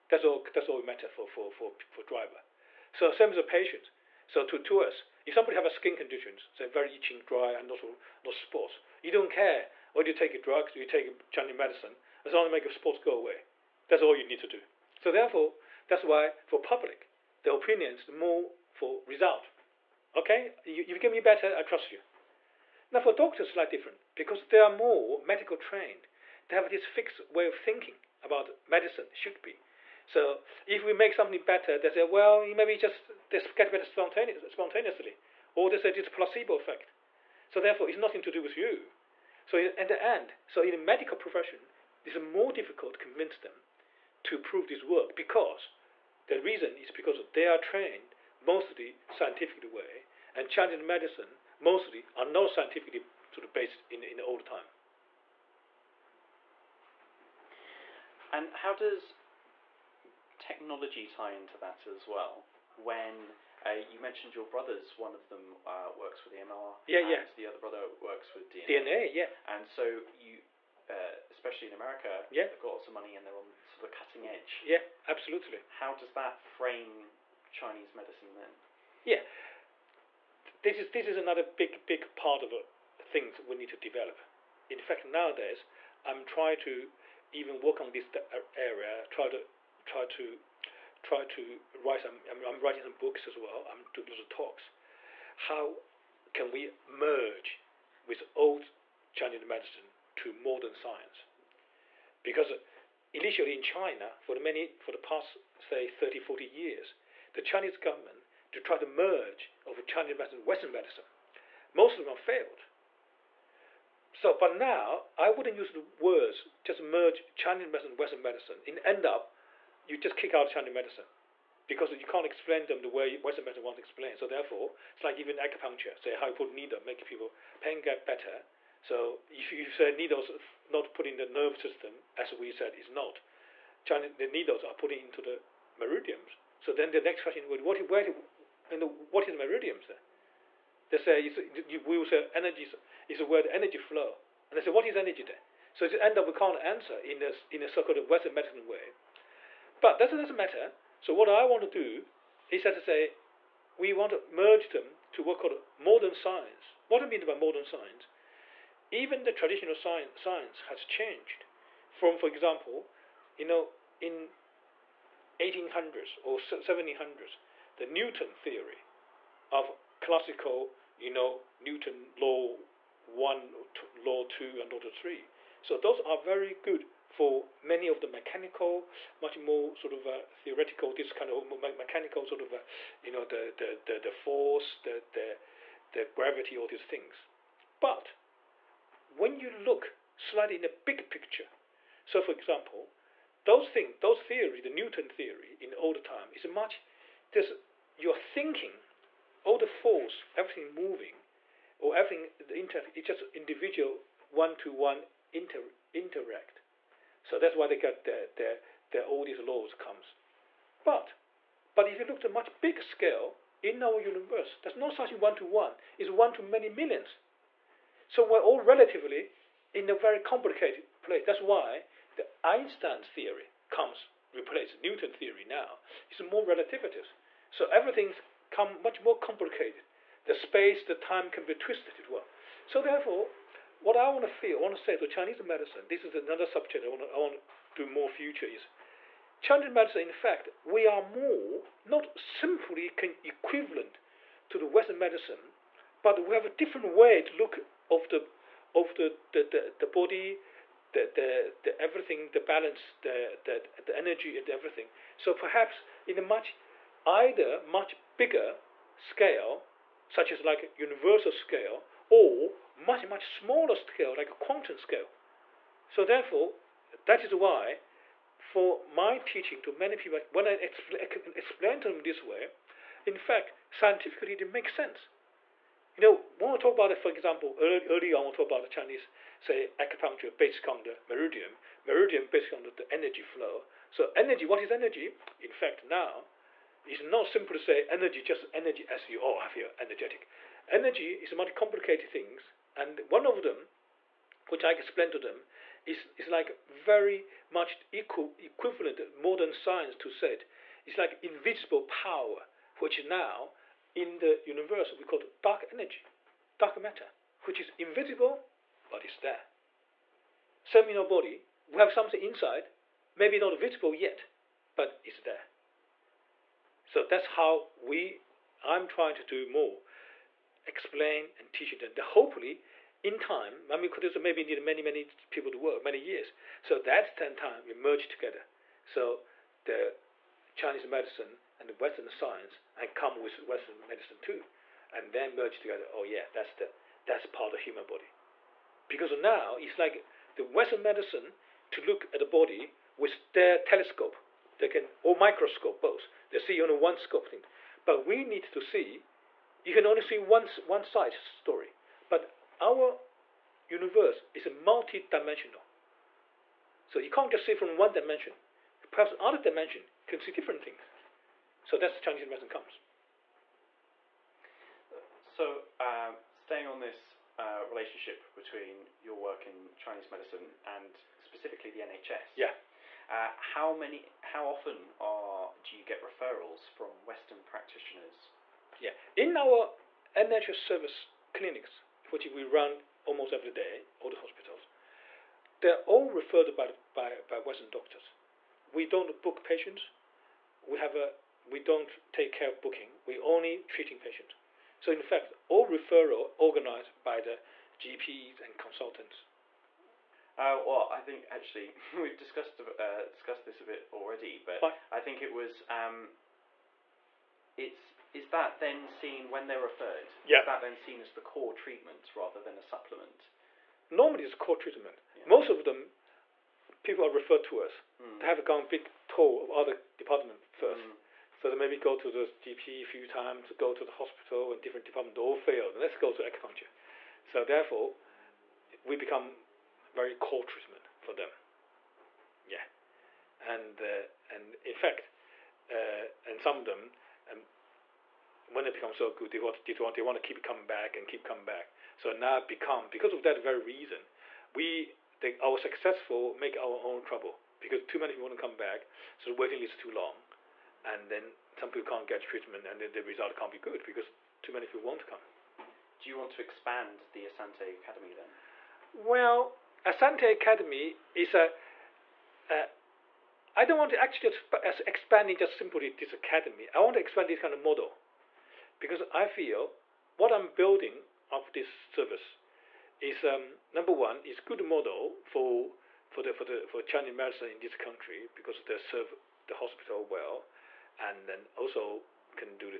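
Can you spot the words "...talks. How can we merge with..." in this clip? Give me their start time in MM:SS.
01:34.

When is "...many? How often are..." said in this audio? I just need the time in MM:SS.
06:13.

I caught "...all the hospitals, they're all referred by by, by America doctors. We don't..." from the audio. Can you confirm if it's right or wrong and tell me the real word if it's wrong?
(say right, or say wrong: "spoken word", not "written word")
wrong: "Western", not "America".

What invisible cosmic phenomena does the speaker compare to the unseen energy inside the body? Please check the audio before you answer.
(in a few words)
Dark energy, dark matter.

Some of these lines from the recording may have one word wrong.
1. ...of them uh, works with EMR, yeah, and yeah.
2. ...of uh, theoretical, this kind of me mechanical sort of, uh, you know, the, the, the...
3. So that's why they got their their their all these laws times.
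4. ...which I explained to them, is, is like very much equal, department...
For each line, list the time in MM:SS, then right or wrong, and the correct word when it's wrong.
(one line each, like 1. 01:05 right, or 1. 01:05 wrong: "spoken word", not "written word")
1. 01:05 right
2. 02:59 right
3. 03:27 wrong: "comes", not "times"
4. 04:54 wrong: "equivalent", not "department".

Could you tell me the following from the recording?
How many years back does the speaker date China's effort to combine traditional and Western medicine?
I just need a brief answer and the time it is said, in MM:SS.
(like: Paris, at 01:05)
30, 40 years, at 01:45.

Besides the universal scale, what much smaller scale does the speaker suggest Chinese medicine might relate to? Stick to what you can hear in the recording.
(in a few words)
Quantum scale.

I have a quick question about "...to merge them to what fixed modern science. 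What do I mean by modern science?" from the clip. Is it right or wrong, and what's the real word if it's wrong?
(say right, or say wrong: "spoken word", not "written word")
wrong: "called", not "fixed".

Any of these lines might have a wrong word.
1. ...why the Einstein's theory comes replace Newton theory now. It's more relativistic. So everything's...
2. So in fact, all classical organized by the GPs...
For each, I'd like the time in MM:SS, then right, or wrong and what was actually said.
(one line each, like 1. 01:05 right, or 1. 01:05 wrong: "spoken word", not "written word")
1. 03:41 right
2. 06:34 wrong: "referral", not "classical".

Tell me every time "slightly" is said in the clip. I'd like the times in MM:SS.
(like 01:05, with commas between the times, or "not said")
00:23, 03:10.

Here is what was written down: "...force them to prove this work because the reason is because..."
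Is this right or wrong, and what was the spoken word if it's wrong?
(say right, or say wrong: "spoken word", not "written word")
wrong: "convince", not "force".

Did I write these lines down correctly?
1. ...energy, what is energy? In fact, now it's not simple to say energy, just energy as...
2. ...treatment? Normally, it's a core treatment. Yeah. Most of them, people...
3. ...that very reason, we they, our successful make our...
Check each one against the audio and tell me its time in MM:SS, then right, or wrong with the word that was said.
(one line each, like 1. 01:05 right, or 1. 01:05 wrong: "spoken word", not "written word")
1. 04:44 right
2. 06:52 wrong: "supplement", not "treatment"
3. 07:23 right.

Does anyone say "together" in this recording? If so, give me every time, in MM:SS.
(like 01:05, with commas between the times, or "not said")
05:28, 05:35.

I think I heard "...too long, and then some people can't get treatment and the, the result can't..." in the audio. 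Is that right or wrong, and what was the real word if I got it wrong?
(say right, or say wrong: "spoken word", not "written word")
right.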